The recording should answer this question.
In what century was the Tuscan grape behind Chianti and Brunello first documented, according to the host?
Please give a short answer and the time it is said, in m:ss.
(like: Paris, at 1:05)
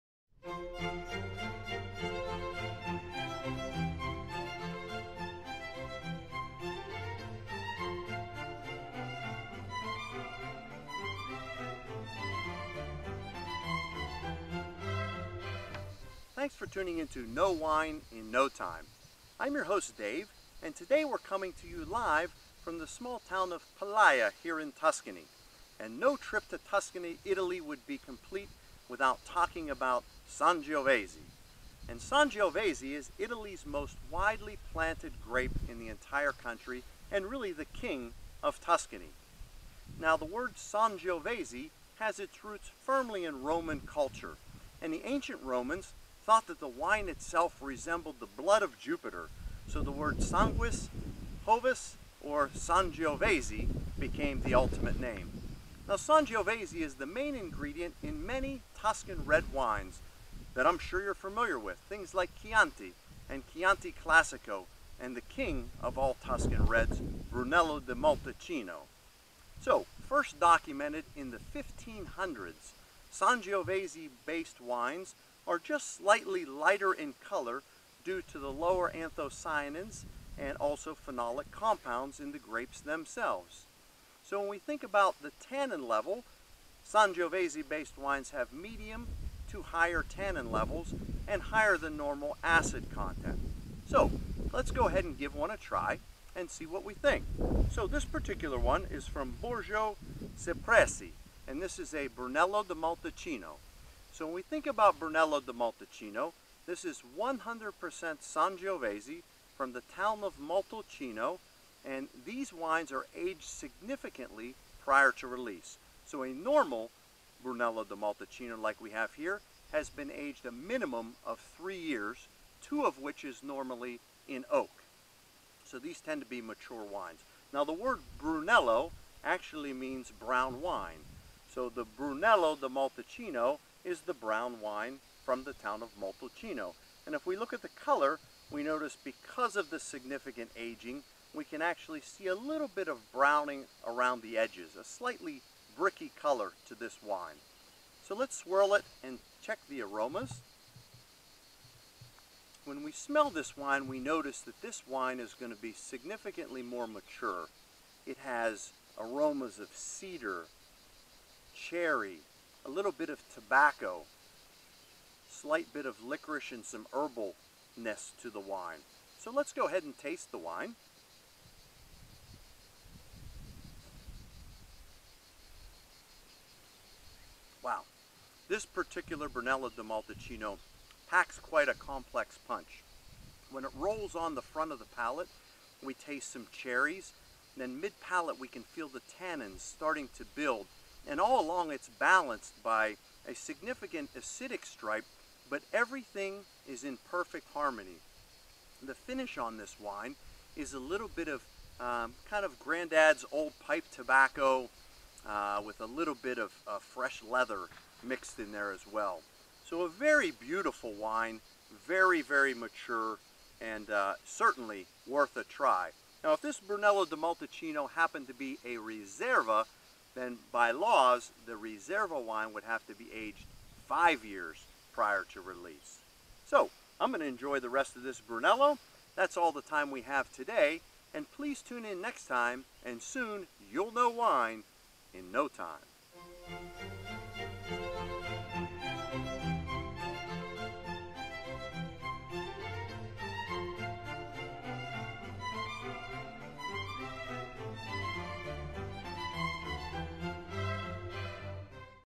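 1500s, at 1:11.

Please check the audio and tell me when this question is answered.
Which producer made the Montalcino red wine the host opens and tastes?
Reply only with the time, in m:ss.
1:39.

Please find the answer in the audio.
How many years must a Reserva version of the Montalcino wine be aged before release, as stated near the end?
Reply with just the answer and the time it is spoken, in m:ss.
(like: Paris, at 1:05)
5, at 3:43.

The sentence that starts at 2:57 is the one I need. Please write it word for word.
Wow, this particular Brunello di Montalcino packs quite a complex punch.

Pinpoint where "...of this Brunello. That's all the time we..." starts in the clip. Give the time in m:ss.
3:47.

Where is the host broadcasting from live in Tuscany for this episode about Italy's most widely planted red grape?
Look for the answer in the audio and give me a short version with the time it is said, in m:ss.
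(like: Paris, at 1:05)
Palaia, at 0:23.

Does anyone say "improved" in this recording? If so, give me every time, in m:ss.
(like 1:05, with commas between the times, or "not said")
not said.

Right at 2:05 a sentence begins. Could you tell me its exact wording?
So these tend to be mature wines.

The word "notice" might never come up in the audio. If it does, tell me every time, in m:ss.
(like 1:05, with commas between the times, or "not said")
2:18, 2:33.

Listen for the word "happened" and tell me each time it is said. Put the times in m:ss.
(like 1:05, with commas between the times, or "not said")
3:37.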